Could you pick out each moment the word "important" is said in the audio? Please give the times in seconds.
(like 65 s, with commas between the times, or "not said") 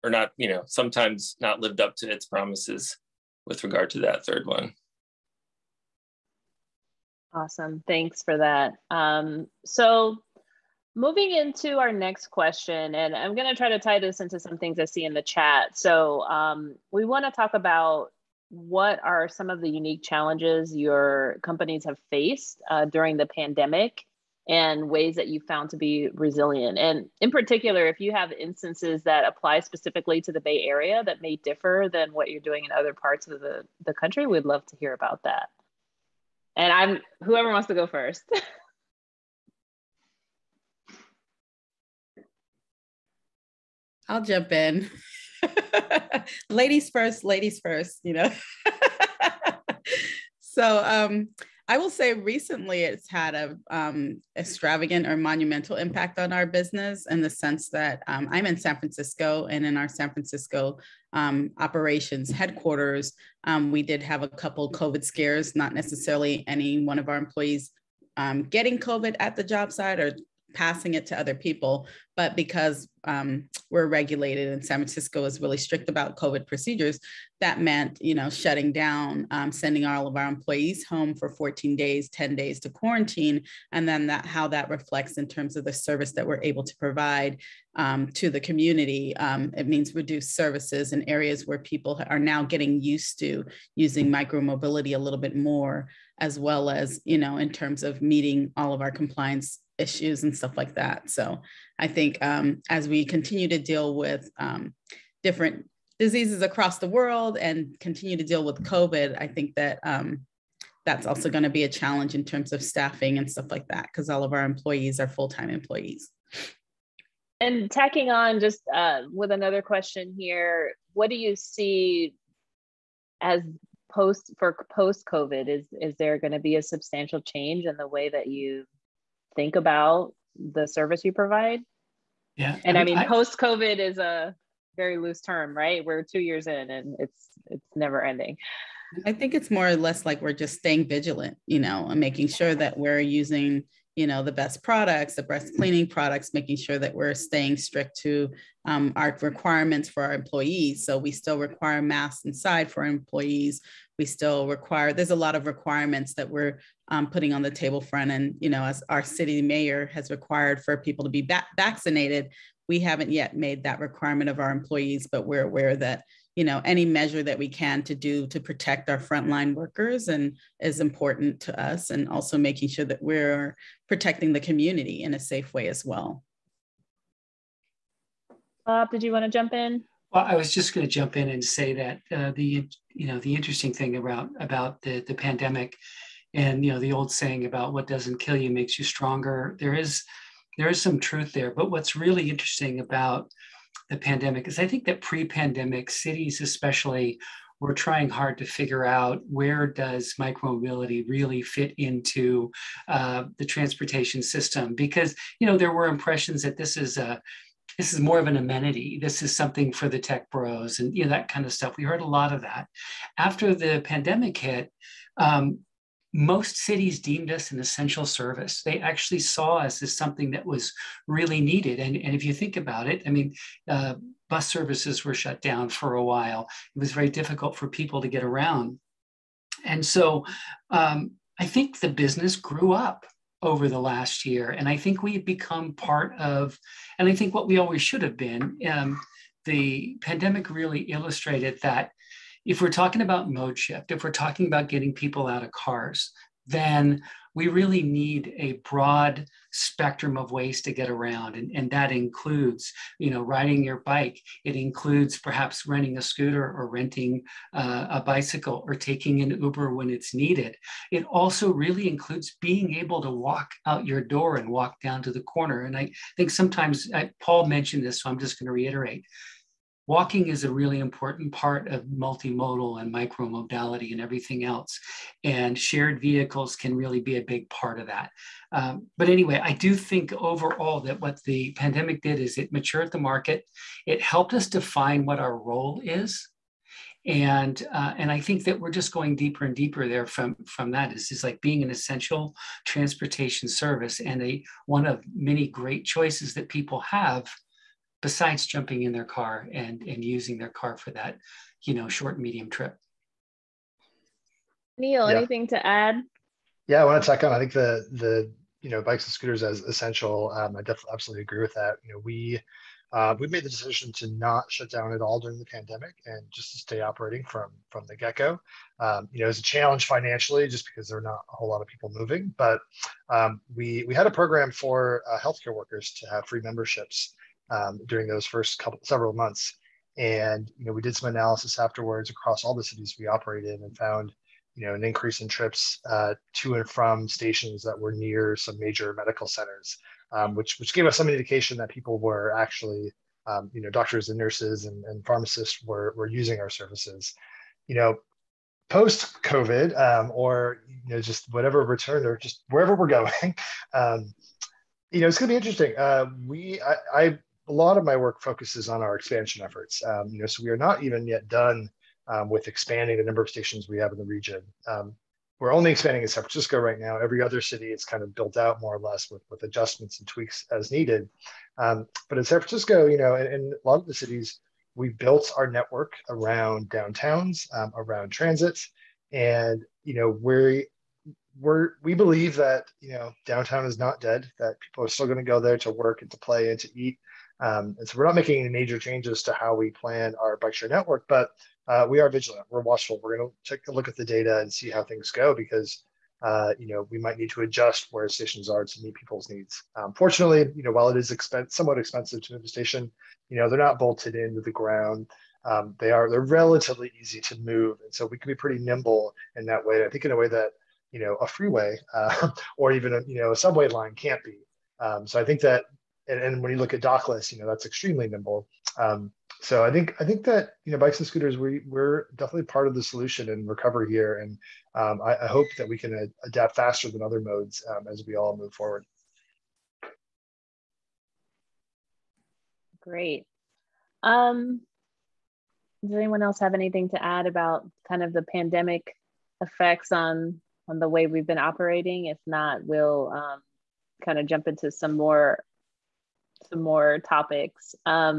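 170 s, 270 s.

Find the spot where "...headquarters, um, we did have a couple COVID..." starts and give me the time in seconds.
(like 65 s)
62 s.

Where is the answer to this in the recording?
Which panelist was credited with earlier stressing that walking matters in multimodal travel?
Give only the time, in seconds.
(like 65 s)
267 s.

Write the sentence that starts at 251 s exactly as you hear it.
And, and that includes, you know, riding your bike.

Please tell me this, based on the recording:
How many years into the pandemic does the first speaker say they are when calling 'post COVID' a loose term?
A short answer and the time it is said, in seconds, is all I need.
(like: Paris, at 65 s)
2, at 136 s.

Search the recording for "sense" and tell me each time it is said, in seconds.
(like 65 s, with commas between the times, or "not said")
57 s.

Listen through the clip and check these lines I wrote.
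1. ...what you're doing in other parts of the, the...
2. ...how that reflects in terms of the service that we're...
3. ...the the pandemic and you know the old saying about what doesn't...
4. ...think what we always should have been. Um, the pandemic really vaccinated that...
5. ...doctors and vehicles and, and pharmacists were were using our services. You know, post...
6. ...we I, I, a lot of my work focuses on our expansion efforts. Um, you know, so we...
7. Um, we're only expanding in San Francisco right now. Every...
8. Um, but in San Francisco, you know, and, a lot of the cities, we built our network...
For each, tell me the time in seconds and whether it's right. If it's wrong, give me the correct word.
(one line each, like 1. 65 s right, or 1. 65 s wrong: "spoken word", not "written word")
1. 32 s right
2. 84 s right
3. 184 s right
4. 237 s wrong: "illustrated", not "vaccinated"
5. 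343 s wrong: "nurses", not "vehicles"
6. 356 s right
7. 364 s right
8. 371 s right.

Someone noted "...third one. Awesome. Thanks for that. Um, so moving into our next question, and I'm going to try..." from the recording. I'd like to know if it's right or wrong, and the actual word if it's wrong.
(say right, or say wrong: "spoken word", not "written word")
right.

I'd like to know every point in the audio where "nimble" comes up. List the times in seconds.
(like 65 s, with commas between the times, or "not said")
408 s, 418 s.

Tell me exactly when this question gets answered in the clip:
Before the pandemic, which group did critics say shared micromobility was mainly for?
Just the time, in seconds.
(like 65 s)
209 s.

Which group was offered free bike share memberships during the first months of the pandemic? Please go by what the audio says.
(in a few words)
healthcare workers.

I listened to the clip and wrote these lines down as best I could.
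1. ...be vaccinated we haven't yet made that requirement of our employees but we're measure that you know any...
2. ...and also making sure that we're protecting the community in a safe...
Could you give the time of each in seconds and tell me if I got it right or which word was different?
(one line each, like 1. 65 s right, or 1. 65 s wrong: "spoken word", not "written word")
1. 161 s wrong: "aware", not "measure"
2. 171 s right.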